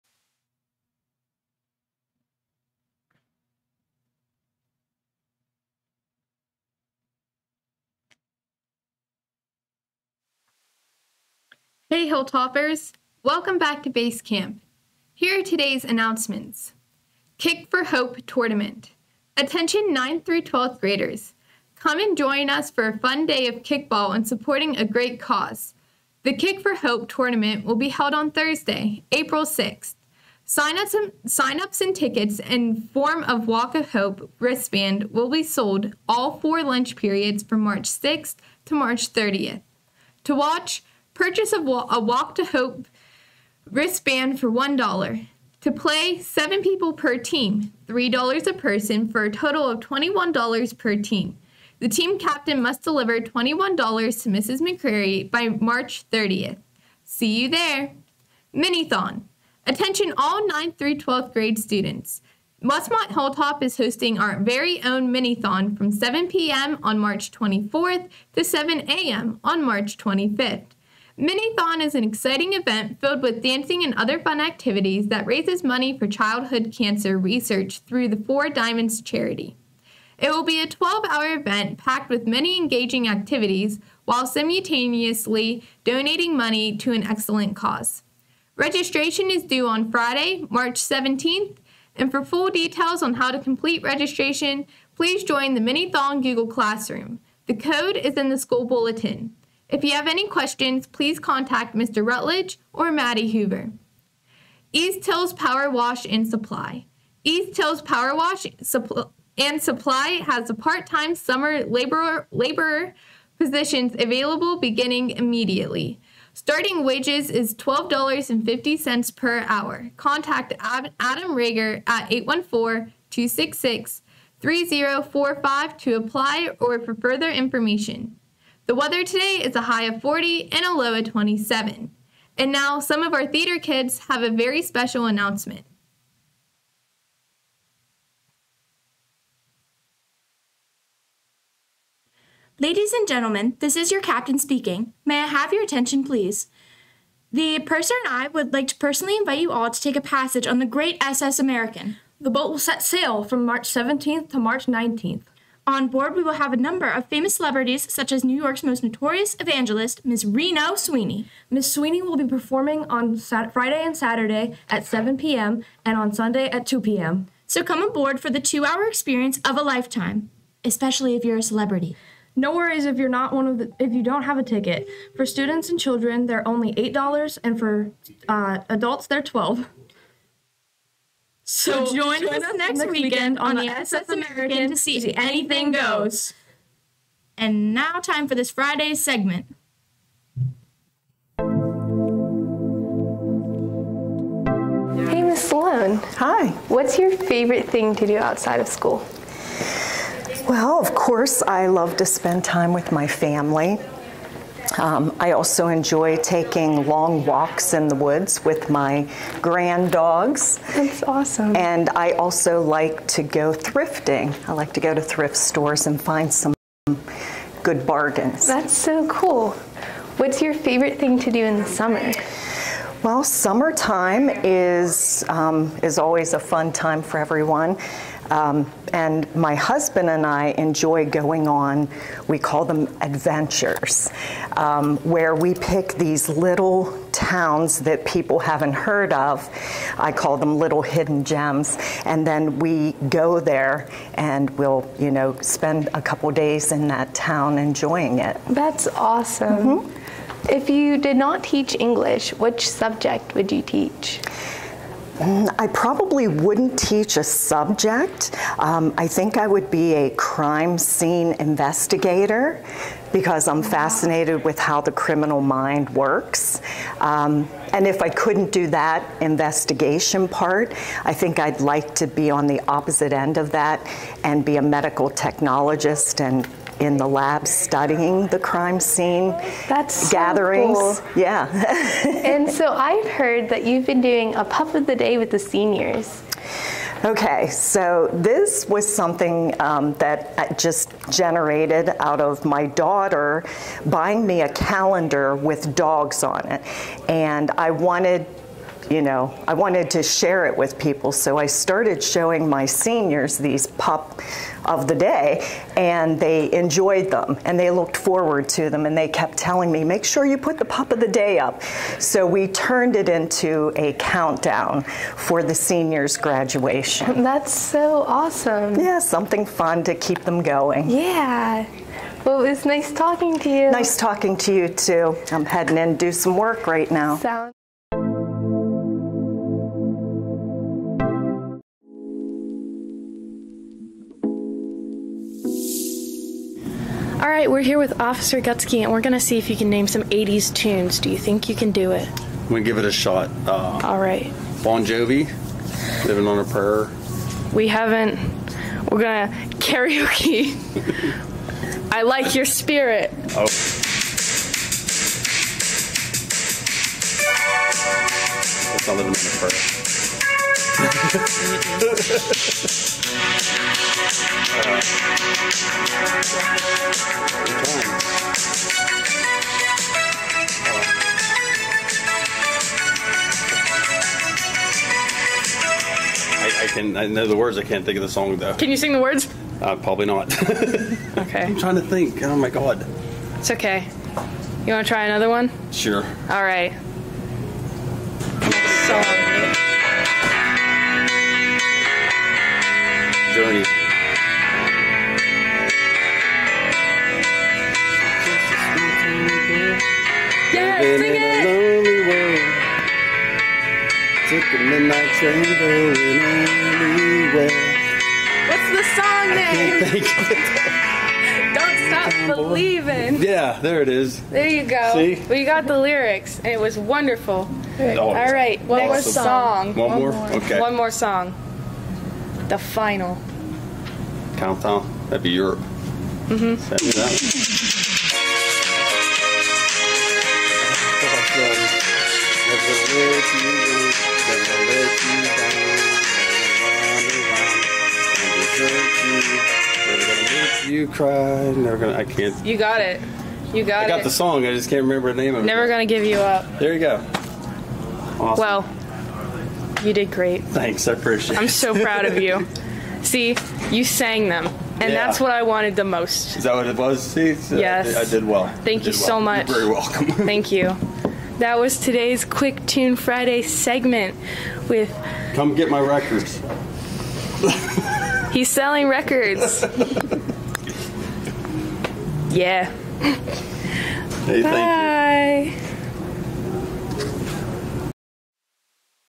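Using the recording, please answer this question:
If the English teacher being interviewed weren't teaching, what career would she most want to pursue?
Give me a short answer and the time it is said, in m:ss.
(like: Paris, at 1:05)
Crime scene investigator, at 4:20.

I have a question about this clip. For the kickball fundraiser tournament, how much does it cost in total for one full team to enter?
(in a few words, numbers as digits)
$21.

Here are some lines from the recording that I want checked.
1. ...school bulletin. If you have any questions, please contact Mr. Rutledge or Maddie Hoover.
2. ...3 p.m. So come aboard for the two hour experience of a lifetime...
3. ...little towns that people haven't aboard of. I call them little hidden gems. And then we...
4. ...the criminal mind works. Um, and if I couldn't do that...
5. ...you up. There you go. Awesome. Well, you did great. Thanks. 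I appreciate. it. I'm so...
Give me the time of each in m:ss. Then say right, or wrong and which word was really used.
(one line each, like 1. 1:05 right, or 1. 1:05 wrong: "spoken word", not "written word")
1. 1:38 right
2. 2:46 wrong: "2", not "3"
3. 3:56 wrong: "heard", not "aboard"
4. 4:24 right
5. 7:26 right.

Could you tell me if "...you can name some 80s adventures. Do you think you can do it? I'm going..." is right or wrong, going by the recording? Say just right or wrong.
wrong.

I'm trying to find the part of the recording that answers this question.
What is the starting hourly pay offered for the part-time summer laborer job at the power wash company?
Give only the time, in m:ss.
1:57.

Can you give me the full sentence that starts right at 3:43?
Well, summertime is um, is always a fun time for everyone.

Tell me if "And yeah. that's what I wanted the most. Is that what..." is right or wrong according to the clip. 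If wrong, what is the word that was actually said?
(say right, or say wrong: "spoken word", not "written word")
right.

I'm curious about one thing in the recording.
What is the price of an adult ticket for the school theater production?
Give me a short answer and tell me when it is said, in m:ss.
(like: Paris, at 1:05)
$12, at 2:59.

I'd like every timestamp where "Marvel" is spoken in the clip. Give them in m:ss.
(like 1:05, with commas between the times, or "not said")
not said.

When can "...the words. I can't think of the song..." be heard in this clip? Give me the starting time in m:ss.
6:17.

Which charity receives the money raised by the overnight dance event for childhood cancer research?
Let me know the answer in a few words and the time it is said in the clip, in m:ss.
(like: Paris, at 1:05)
Four Diamonds, at 1:18.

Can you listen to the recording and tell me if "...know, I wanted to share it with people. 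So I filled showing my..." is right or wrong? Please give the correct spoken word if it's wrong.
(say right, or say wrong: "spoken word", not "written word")
wrong: "started", not "filled".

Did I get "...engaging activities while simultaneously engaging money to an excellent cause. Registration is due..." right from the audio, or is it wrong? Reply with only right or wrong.
wrong.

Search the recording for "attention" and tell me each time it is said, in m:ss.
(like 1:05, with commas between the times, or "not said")
0:19, 0:59, 2:25.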